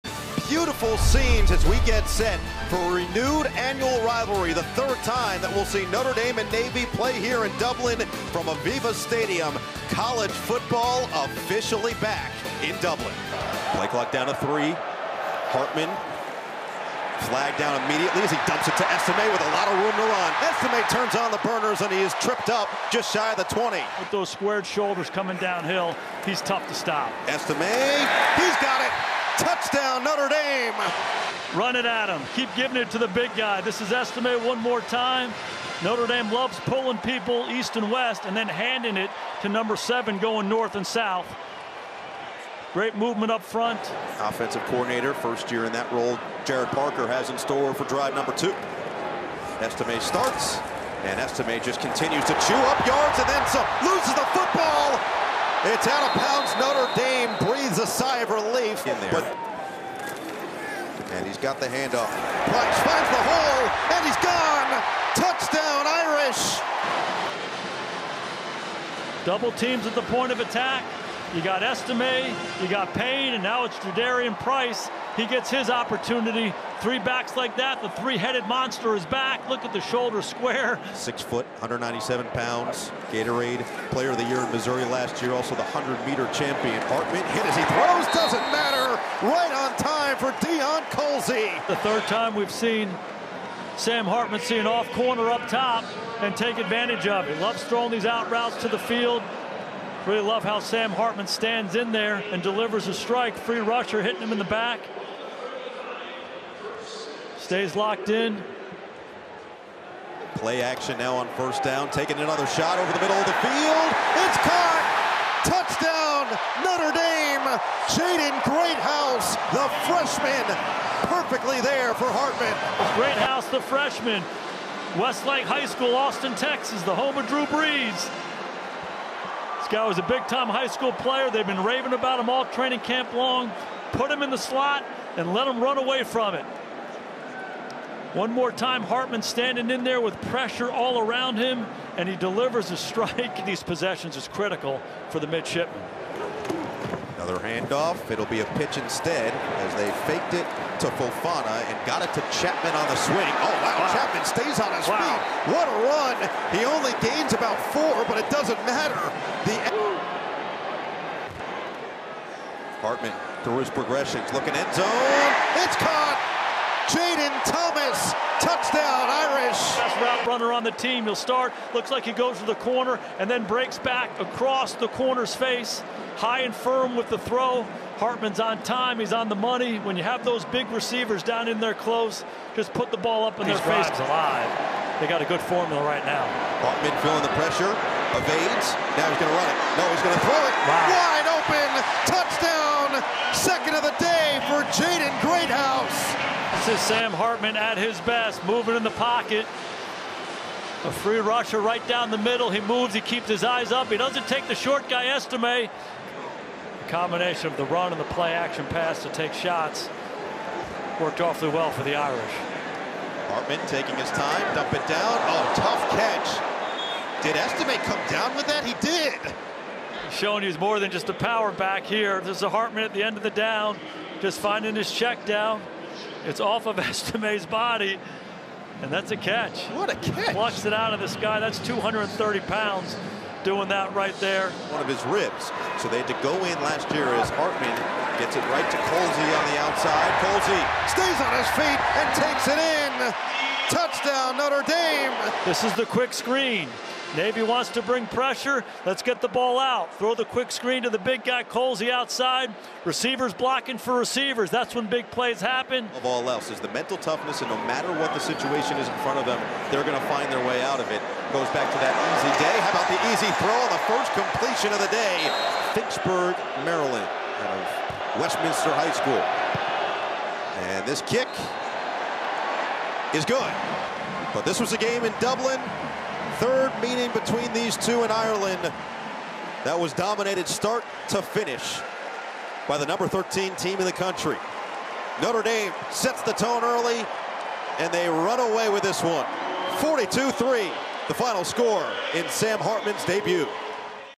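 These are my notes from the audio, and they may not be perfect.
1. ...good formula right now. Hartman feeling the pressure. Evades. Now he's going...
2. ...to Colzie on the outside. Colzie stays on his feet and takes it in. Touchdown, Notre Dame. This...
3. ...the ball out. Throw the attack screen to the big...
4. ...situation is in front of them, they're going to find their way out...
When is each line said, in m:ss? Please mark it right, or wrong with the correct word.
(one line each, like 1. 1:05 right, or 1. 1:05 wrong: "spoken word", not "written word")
1. 3:05 right
2. 3:58 right
3. 4:09 wrong: "quick", not "attack"
4. 4:18 right.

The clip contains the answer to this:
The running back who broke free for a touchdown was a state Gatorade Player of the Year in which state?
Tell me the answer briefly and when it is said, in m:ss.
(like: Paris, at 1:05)
Missouri, at 1:24.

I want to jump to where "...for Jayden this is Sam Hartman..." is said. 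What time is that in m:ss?
3:14.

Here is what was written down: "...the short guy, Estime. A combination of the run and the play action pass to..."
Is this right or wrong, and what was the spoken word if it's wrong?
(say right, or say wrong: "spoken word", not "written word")
right.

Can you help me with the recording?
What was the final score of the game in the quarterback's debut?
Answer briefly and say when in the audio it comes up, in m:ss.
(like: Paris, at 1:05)
42-3, at 4:49.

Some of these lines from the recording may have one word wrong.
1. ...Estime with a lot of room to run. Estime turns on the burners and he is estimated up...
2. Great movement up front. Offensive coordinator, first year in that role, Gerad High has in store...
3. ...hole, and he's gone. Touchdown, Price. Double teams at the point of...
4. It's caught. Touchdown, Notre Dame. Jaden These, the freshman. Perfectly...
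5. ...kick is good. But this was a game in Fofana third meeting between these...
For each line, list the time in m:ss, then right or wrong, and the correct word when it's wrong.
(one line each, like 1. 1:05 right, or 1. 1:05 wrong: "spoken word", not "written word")
1. 0:18 wrong: "tripped", not "estimated"
2. 0:42 wrong: "Parker", not "High"
3. 1:03 wrong: "Irish", not "Price"
4. 1:54 wrong: "Greathouse", not "These"
5. 4:31 wrong: "Dublin", not "Fofana".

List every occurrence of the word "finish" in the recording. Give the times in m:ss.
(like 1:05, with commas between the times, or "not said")
4:41.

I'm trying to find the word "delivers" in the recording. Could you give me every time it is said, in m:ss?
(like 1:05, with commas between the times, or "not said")
1:42, 2:22.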